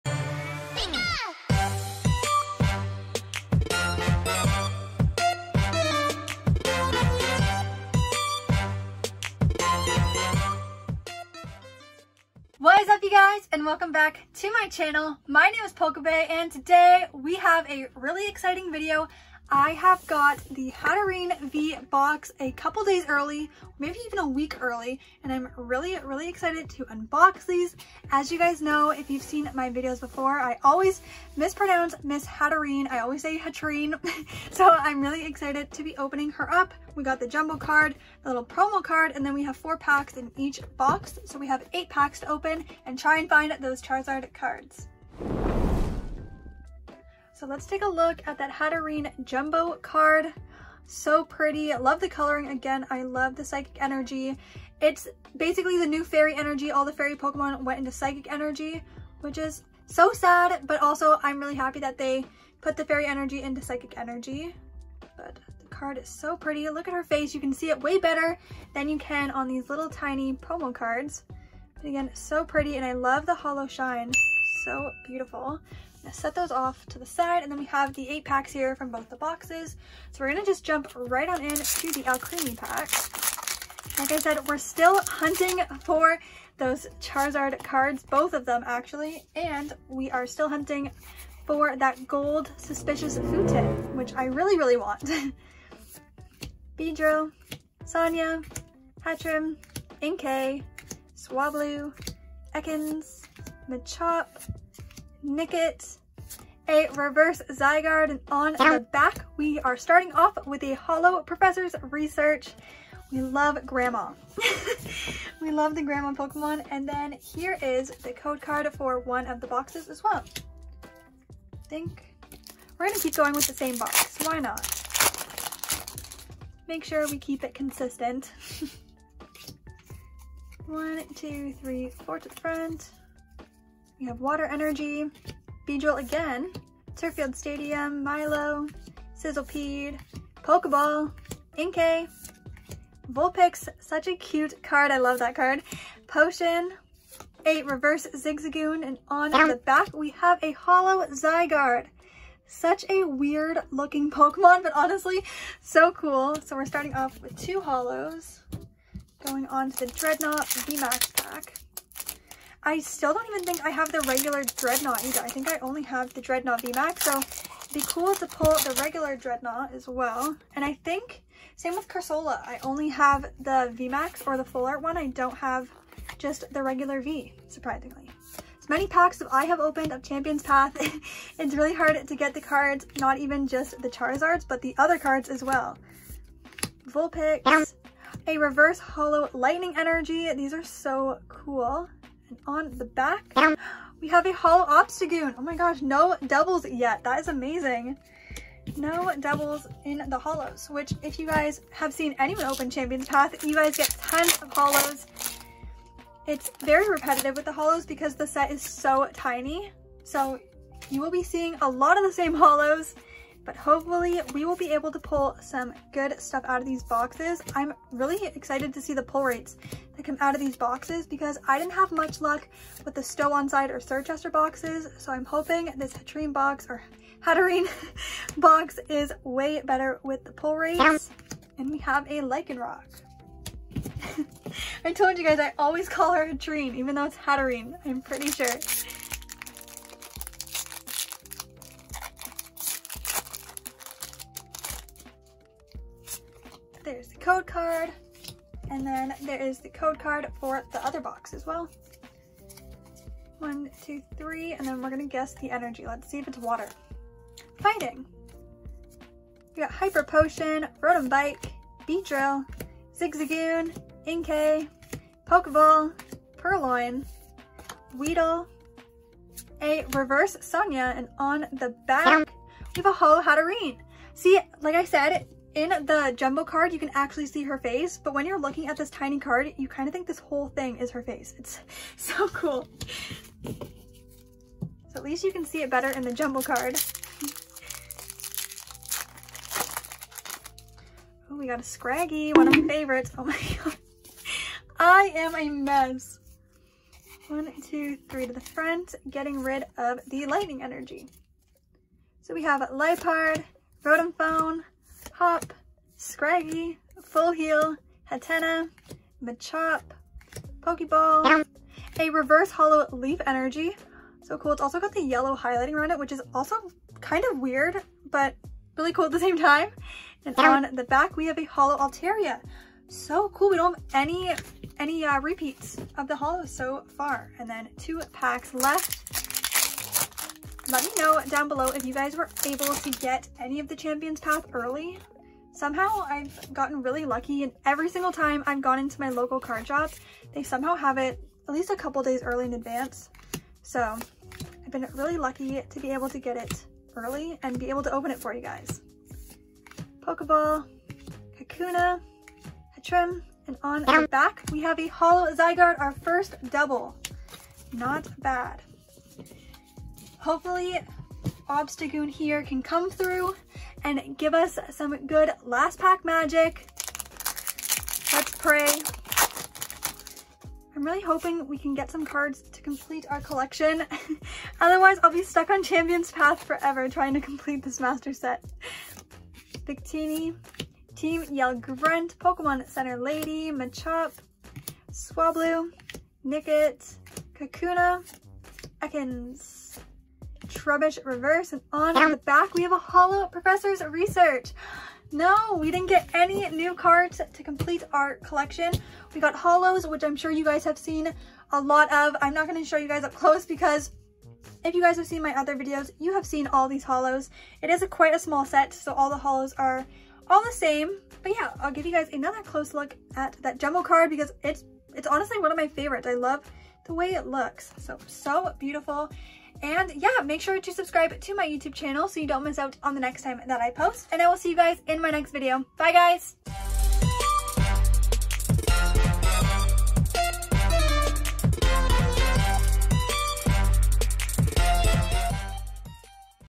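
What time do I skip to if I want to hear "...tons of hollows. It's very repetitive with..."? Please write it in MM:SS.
03:24.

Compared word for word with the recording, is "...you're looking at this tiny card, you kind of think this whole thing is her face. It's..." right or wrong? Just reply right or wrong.
right.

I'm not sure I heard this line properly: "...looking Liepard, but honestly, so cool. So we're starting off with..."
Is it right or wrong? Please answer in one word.
wrong.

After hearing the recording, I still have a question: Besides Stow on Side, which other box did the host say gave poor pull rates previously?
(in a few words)
Circhester.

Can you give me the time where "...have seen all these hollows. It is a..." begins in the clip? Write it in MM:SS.
06:46.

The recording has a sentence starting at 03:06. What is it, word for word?
Vulpix, a reverse hollow lightning energy.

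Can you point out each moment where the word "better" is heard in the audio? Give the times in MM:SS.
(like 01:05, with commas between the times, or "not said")
01:07, 03:49, 04:45.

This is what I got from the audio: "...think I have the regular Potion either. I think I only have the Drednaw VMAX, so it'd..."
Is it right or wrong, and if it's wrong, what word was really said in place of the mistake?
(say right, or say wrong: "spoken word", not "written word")
wrong: "Drednaw", not "Potion".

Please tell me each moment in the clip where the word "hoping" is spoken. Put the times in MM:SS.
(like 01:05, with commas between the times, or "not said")
03:45, 06:11.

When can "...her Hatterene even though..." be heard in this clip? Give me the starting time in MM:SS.
03:56.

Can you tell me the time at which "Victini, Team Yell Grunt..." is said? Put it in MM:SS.
06:19.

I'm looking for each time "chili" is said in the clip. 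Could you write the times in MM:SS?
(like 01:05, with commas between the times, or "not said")
not said.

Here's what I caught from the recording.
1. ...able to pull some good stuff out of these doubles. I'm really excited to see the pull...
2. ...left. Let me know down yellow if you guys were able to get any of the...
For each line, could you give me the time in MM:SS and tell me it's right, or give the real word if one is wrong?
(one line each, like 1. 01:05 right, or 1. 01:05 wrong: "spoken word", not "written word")
1. 03:34 wrong: "boxes", not "doubles"
2. 05:28 wrong: "below", not "yellow".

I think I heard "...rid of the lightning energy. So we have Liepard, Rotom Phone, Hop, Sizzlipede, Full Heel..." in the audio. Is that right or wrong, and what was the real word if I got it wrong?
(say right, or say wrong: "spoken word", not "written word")
wrong: "Scraggy", not "Sizzlipede".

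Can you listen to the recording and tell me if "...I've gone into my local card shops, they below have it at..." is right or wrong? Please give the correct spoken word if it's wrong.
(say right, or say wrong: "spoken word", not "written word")
wrong: "somehow", not "below".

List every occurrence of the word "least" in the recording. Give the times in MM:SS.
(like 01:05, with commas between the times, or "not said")
04:45, 05:41.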